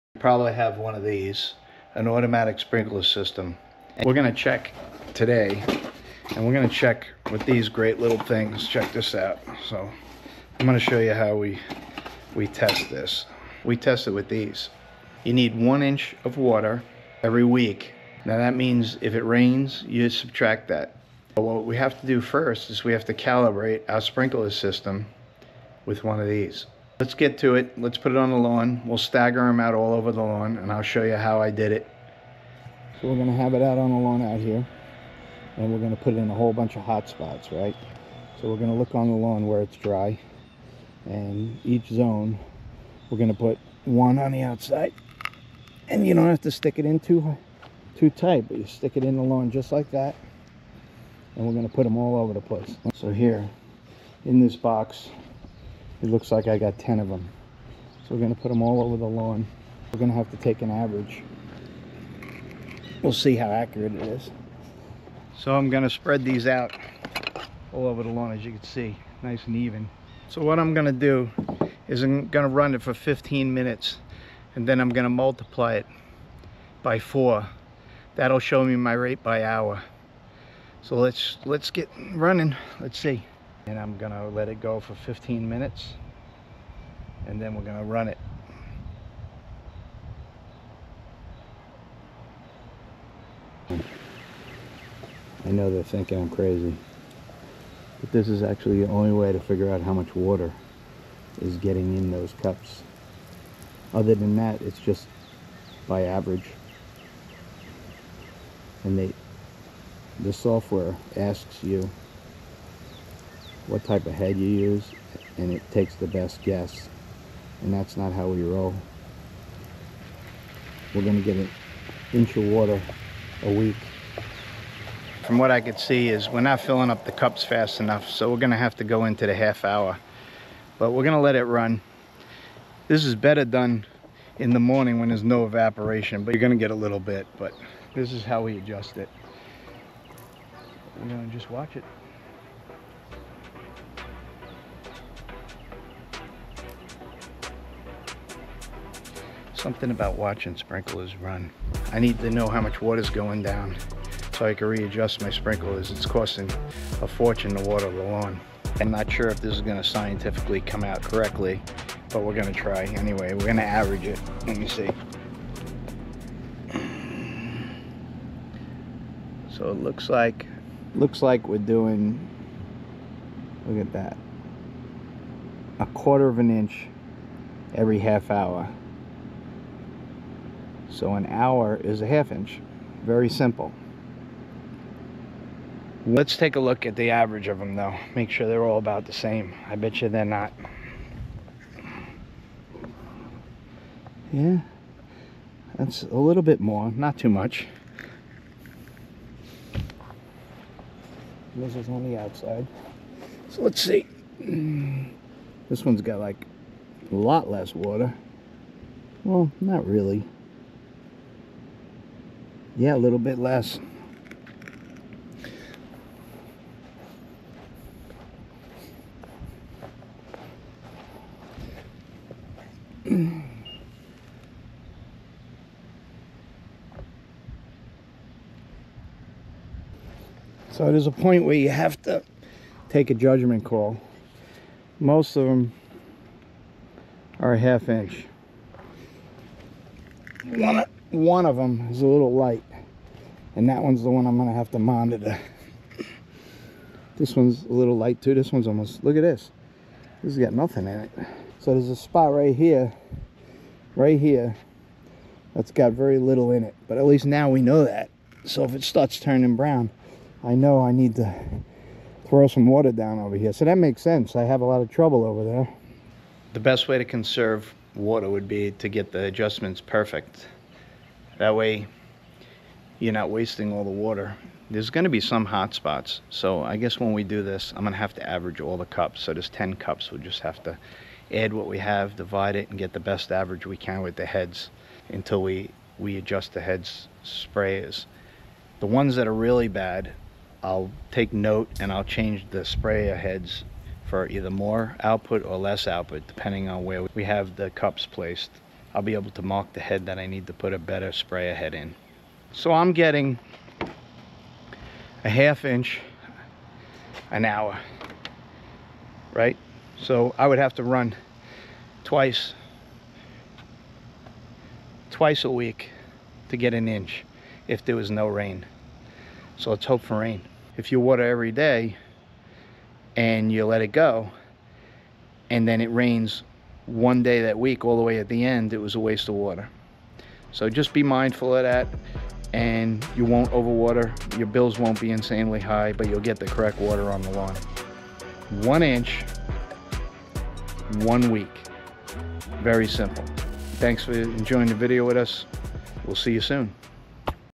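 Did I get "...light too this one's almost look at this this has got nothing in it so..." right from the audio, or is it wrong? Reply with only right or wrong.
right.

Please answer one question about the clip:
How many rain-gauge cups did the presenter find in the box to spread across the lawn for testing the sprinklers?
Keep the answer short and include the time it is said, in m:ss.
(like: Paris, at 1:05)
10, at 0:56.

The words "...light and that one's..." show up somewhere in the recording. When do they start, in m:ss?
4:02.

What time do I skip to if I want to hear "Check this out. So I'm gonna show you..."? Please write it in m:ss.
0:08.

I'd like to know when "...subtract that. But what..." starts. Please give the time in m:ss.
0:20.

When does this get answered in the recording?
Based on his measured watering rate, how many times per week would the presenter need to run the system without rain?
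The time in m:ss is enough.
5:15.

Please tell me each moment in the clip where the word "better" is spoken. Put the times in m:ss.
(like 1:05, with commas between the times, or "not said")
2:13, 5:00.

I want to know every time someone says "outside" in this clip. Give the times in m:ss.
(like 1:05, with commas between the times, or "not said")
0:44, 3:22.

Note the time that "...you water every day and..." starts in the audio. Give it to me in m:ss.
5:20.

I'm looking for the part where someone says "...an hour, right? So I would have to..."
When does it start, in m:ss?
5:07.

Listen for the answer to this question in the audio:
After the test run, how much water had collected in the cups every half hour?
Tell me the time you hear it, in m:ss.
2:55.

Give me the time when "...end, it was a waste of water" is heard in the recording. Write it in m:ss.
5:28.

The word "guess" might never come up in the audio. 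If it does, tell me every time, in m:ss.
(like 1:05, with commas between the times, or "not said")
1:56, 4:36.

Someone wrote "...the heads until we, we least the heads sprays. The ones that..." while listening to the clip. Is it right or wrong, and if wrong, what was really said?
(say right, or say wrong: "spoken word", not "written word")
wrong: "adjust", not "least".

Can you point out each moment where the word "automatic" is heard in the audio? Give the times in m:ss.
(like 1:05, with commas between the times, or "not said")
0:02.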